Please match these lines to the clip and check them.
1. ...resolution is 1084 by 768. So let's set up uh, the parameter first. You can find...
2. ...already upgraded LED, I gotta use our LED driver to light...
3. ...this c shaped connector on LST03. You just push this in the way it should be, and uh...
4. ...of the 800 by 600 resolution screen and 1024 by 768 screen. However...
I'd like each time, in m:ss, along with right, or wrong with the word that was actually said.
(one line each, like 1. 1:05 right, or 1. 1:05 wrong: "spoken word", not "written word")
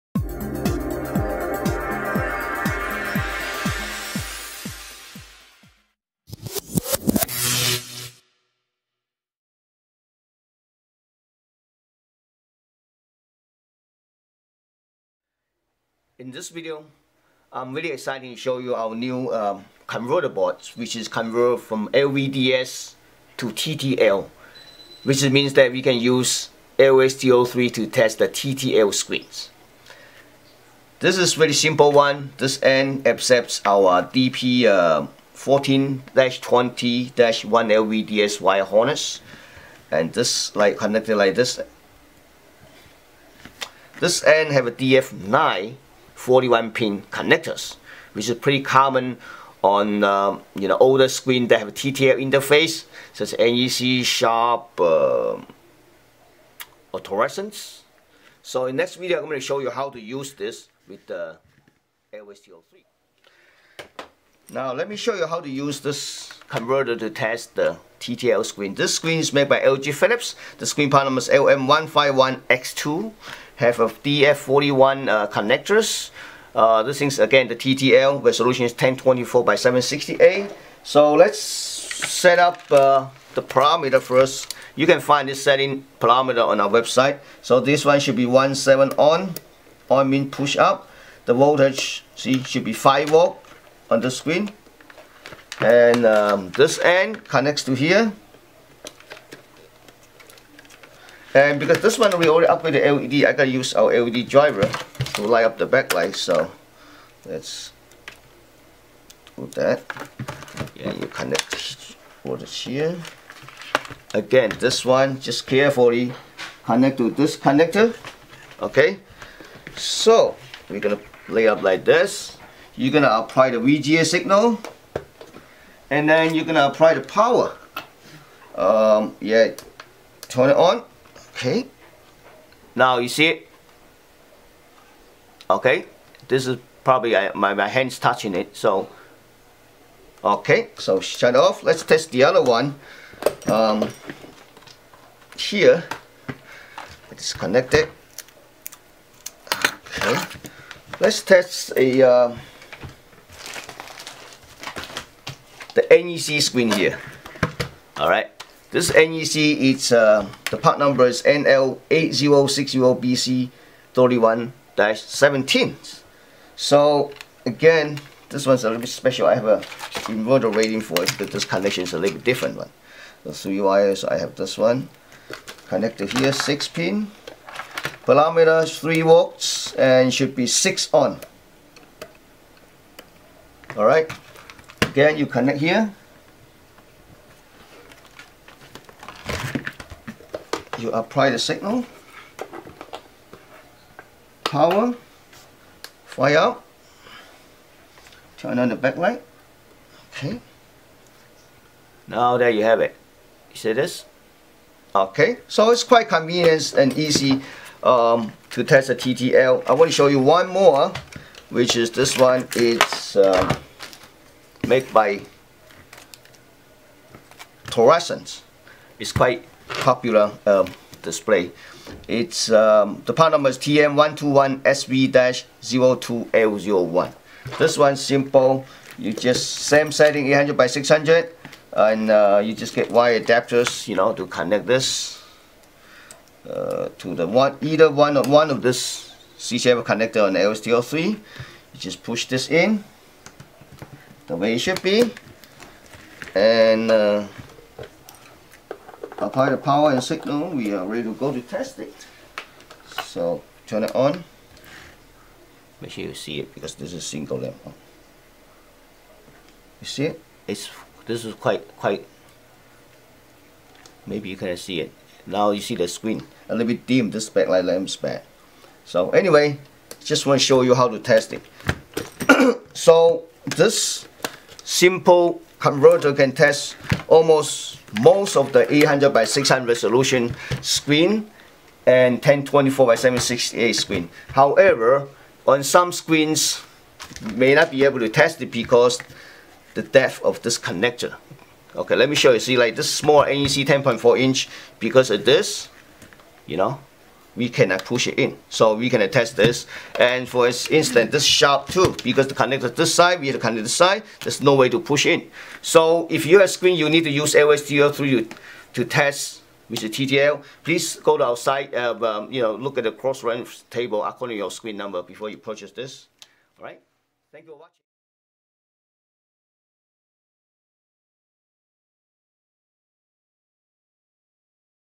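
1. 1:18 wrong: "1024", not "1084"
2. 1:42 right
3. 3:58 right
4. 4:38 right.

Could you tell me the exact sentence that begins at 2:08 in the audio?
Um, yeah, turn it on Okay.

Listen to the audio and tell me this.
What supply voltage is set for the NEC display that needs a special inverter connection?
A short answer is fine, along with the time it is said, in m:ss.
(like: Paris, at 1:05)
3 volts, at 2:58.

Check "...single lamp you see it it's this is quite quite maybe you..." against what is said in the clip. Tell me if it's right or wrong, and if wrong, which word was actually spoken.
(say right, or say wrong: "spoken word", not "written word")
right.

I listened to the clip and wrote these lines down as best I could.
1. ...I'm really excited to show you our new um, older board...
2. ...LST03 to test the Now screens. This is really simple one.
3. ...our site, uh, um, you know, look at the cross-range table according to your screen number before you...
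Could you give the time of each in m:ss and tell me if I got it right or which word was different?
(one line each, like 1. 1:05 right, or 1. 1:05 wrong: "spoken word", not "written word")
1. 0:17 wrong: "converter", not "older"
2. 0:26 wrong: "TTL", not "Now"
3. 5:11 right.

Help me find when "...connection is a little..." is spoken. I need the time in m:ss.
2:51.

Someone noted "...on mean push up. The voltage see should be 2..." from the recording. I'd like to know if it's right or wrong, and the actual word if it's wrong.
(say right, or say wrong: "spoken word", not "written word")
wrong: "5", not "2".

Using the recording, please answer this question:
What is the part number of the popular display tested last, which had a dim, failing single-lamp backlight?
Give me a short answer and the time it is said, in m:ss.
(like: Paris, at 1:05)
TM121SV-02L01, at 3:43.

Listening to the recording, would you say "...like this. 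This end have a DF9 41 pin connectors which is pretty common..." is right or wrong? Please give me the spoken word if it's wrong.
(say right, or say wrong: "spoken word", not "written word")
right.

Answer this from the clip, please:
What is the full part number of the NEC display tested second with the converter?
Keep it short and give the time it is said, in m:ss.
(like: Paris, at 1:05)
NL8060BC31-17, at 2:41.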